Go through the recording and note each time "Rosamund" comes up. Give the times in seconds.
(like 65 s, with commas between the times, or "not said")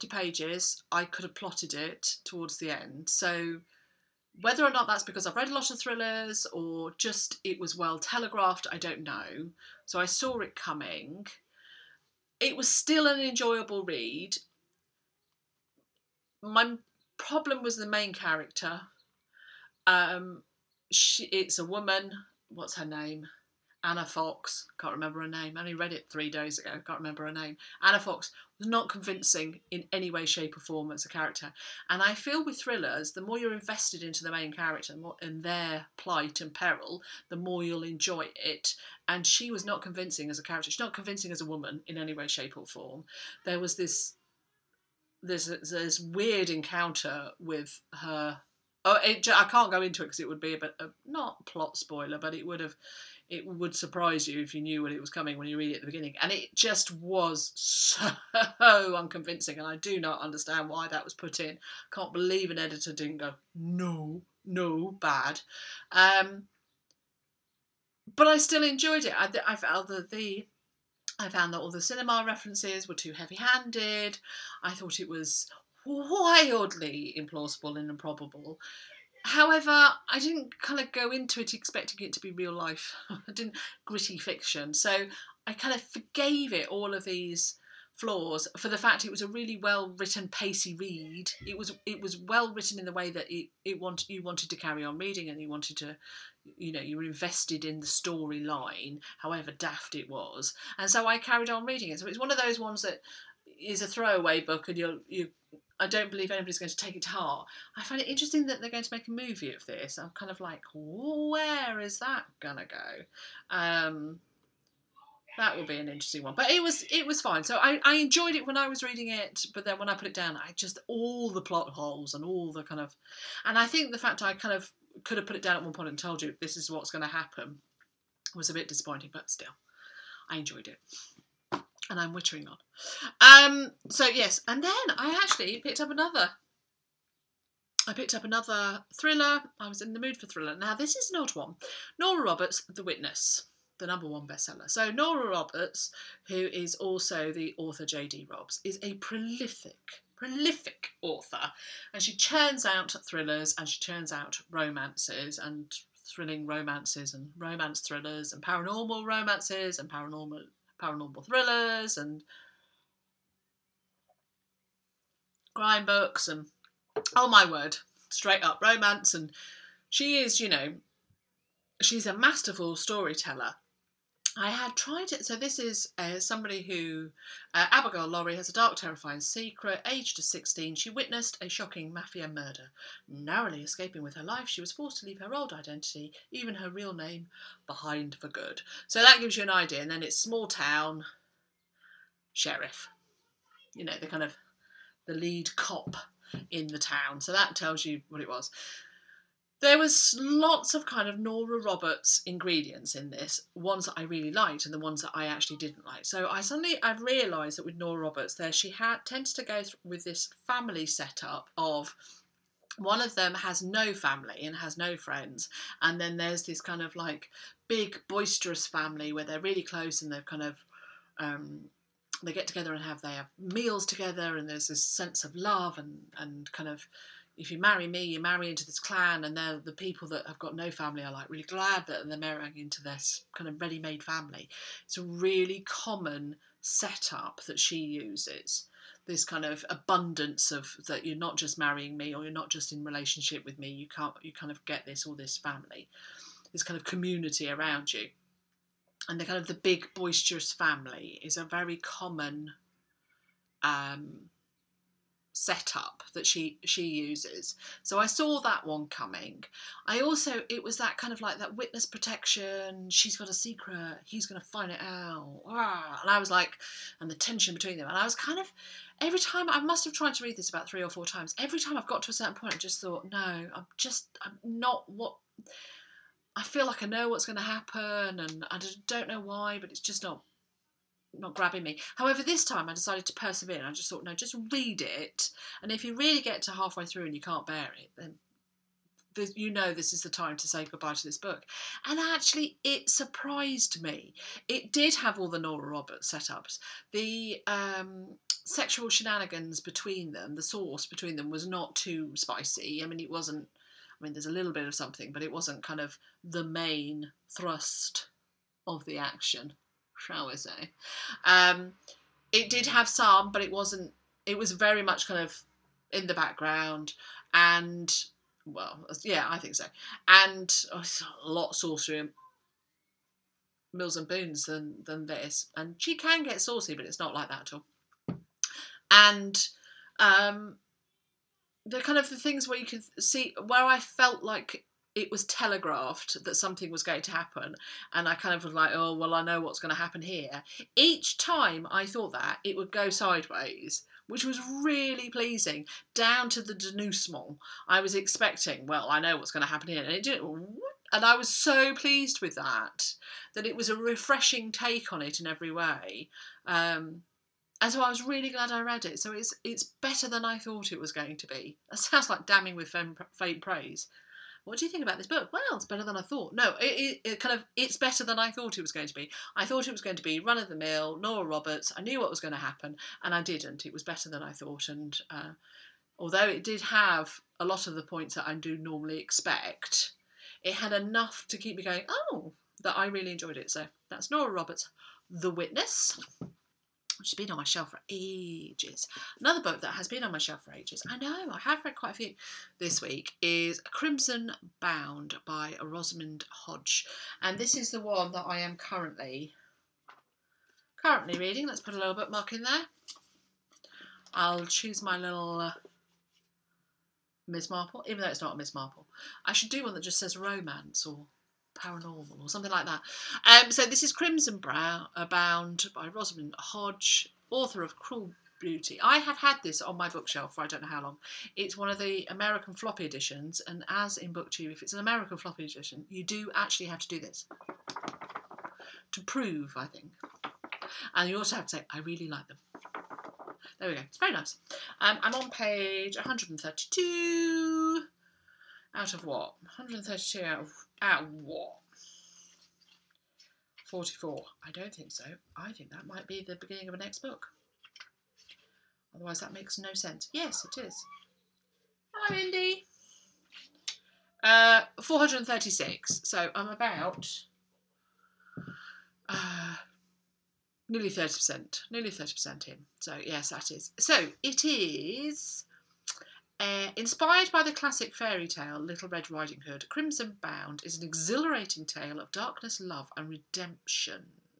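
395 s, 415 s.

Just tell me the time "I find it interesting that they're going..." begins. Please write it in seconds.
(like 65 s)
107 s.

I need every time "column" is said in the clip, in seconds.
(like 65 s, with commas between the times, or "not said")
not said.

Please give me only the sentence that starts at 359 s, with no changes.
So it's it's better than I thought it was going to be.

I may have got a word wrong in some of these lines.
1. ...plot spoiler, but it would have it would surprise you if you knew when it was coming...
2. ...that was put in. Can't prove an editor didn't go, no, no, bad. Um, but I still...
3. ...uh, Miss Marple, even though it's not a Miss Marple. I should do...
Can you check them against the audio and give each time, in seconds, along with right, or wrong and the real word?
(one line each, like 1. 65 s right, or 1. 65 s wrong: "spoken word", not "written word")
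1. 51 s right
2. 60 s wrong: "believe", not "prove"
3. 405 s right.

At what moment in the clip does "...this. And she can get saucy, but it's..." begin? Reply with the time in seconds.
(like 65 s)
325 s.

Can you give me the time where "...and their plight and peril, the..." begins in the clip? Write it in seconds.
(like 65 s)
35 s.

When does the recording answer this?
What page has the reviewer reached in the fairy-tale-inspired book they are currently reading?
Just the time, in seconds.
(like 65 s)
435 s.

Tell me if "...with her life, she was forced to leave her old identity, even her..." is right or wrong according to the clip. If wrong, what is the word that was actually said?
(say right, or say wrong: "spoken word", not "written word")
right.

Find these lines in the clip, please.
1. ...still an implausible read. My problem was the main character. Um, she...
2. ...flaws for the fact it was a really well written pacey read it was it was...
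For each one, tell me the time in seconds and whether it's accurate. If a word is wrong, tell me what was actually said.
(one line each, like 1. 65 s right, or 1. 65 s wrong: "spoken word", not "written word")
1. 12 s wrong: "enjoyable", not "implausible"
2. 87 s right.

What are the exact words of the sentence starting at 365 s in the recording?
Well, it's better than I thought.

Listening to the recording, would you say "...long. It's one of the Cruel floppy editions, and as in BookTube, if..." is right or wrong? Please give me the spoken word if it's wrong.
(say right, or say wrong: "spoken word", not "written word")
wrong: "American", not "Cruel".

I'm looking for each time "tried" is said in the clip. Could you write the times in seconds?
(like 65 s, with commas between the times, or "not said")
174 s, 269 s.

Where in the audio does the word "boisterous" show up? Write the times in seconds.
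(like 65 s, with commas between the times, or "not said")
218 s, 249 s.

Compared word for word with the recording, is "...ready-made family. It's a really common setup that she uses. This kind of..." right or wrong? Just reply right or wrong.
right.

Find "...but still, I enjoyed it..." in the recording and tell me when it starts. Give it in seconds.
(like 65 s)
129 s.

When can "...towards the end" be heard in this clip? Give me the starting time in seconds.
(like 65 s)
2 s.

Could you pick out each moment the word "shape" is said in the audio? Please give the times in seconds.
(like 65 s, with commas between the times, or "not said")
30 s, 42 s.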